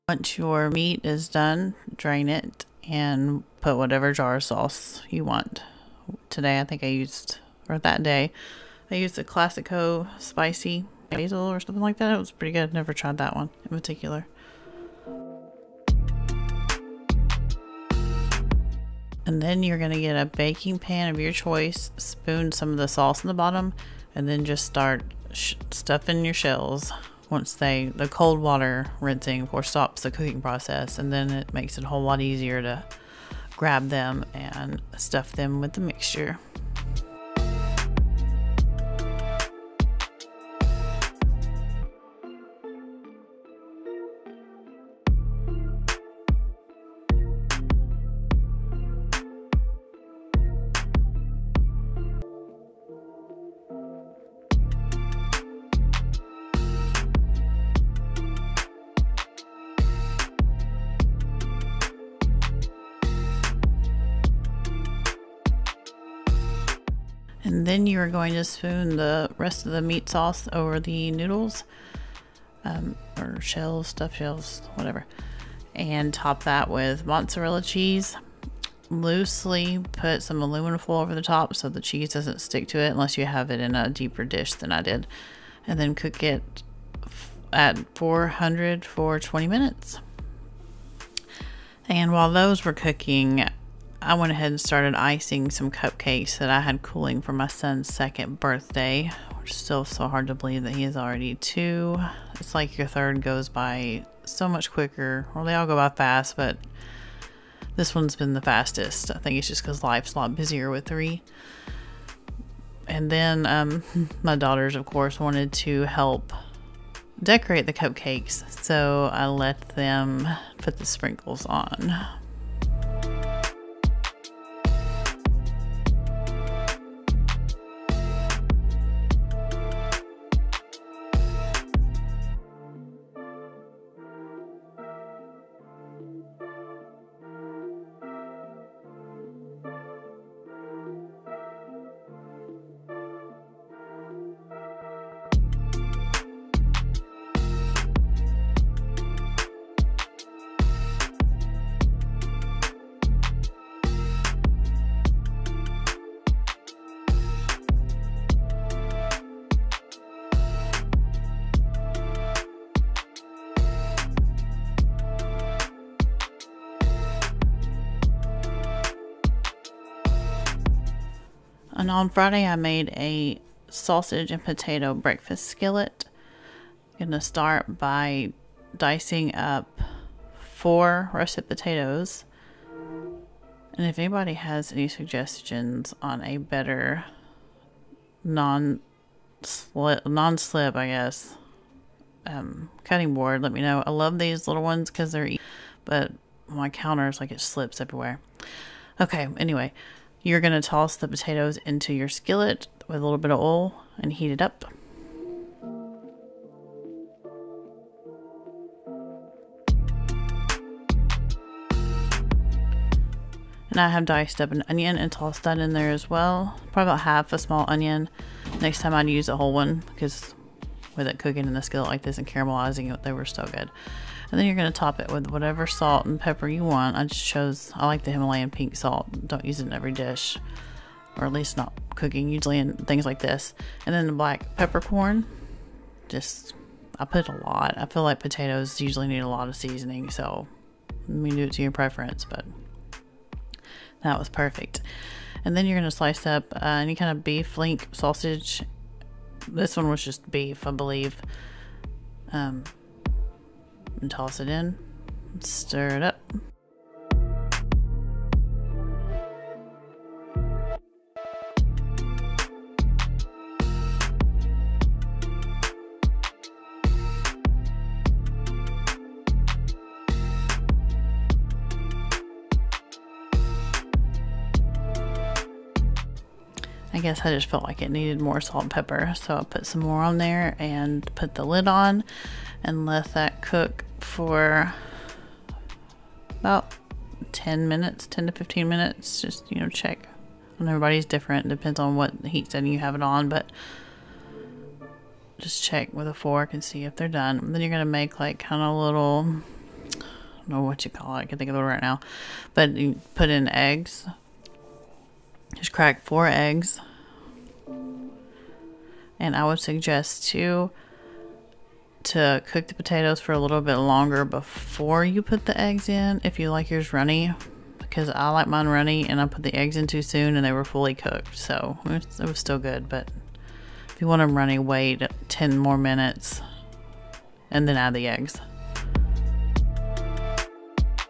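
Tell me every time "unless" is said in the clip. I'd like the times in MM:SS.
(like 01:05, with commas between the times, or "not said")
01:22.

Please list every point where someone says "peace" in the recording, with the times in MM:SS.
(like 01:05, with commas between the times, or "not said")
not said.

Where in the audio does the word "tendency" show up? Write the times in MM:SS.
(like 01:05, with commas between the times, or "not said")
not said.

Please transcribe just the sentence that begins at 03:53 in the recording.
And then the black peppercorn, just, I put a lot.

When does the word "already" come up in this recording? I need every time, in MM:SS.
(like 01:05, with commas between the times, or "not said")
01:40.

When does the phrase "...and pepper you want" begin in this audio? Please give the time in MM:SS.
03:46.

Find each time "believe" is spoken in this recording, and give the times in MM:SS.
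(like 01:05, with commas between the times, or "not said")
01:40, 04:10.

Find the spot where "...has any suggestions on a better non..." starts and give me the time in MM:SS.
03:04.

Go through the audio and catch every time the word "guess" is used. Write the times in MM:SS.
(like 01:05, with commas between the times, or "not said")
03:10, 04:36.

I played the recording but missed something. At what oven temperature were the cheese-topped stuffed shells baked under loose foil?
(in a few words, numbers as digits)
400.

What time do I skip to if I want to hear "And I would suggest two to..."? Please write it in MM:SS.
05:09.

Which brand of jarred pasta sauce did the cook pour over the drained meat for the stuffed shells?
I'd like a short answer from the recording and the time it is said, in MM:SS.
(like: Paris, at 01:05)
Classico, at 00:09.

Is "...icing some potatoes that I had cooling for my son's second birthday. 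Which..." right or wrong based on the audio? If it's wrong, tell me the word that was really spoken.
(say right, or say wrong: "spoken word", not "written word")
wrong: "cupcakes", not "potatoes".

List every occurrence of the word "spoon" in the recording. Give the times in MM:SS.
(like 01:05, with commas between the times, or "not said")
00:21, 01:08.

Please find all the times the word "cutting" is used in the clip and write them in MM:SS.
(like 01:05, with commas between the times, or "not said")
03:12.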